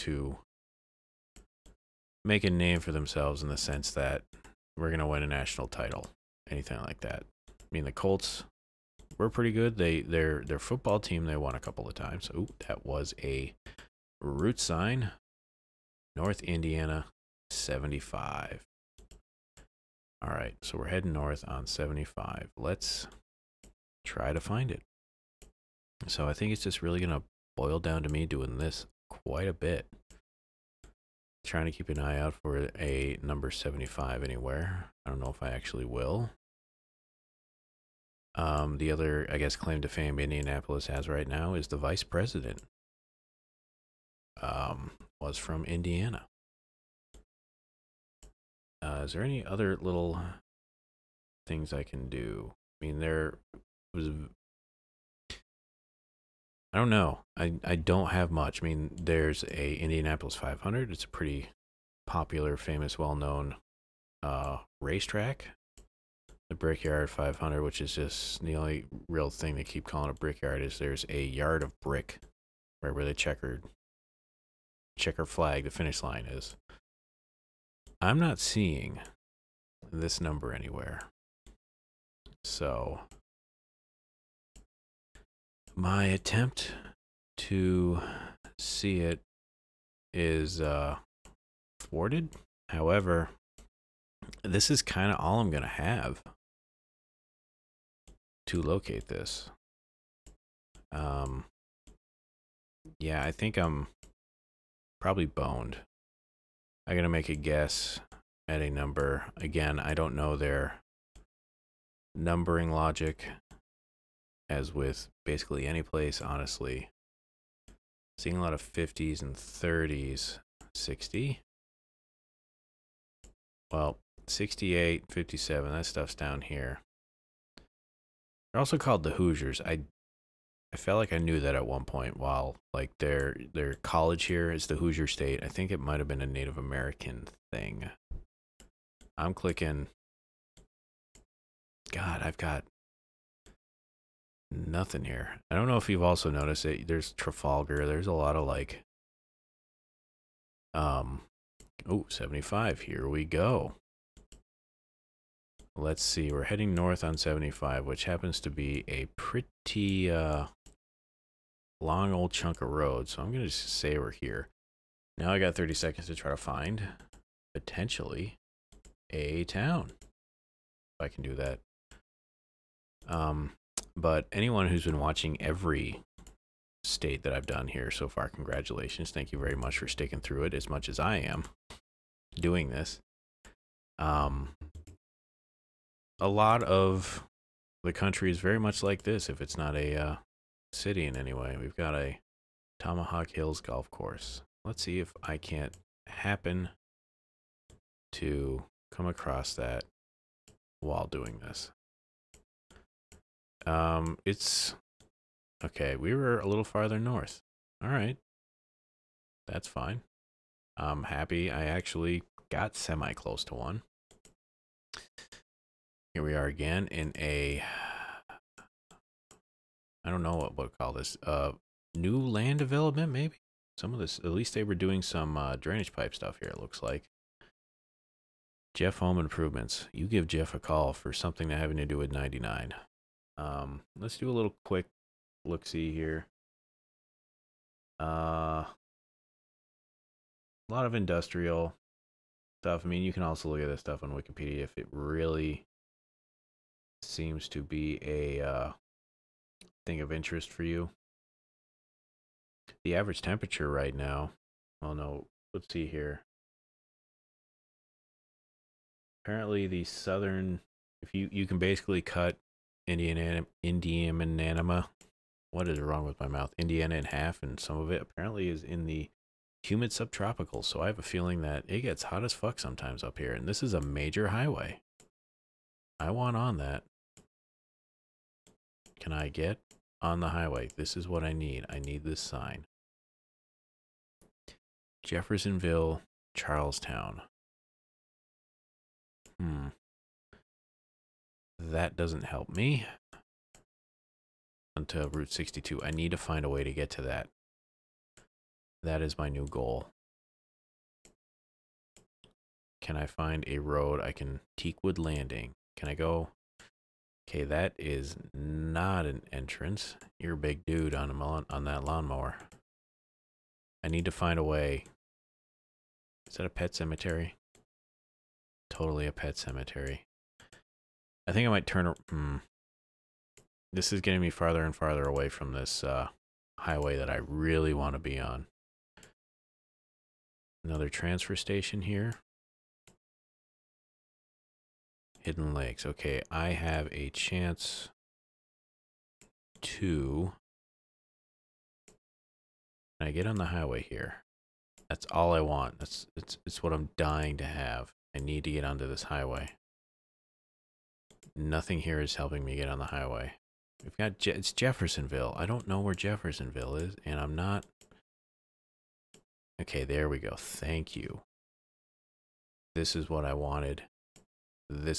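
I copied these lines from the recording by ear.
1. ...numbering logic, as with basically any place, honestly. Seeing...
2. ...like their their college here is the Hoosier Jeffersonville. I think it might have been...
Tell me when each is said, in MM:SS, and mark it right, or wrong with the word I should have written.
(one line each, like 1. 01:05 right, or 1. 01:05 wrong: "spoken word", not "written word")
1. 01:52 right
2. 02:12 wrong: "State", not "Jeffersonville".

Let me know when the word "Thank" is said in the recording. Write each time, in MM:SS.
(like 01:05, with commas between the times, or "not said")
02:59, 06:00.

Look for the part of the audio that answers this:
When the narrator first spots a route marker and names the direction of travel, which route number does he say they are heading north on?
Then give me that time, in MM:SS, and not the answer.
00:16.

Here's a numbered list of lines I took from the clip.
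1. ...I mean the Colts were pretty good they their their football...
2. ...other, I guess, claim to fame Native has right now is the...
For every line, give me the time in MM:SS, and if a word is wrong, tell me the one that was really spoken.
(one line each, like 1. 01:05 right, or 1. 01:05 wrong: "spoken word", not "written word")
1. 00:07 right
2. 00:38 wrong: "Indianapolis", not "Native".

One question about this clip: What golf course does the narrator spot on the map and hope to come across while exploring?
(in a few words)
Tomahawk Hills.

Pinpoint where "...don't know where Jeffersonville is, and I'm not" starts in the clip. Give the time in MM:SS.
05:55.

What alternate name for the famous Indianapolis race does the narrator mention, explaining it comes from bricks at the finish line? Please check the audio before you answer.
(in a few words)
Brickyard 500.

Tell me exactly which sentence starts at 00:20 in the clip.
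All right, so we're heading north on 75.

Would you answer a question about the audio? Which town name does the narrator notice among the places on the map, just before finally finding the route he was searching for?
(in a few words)
Trafalgar.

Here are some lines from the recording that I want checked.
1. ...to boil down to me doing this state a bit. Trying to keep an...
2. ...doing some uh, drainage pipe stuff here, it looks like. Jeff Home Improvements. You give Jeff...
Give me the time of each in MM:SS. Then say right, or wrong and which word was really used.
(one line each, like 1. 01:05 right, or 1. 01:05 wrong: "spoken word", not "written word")
1. 00:27 wrong: "quite", not "state"
2. 03:44 right.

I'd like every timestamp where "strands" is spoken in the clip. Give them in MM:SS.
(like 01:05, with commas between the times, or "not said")
not said.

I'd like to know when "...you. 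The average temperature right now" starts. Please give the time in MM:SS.
04:10.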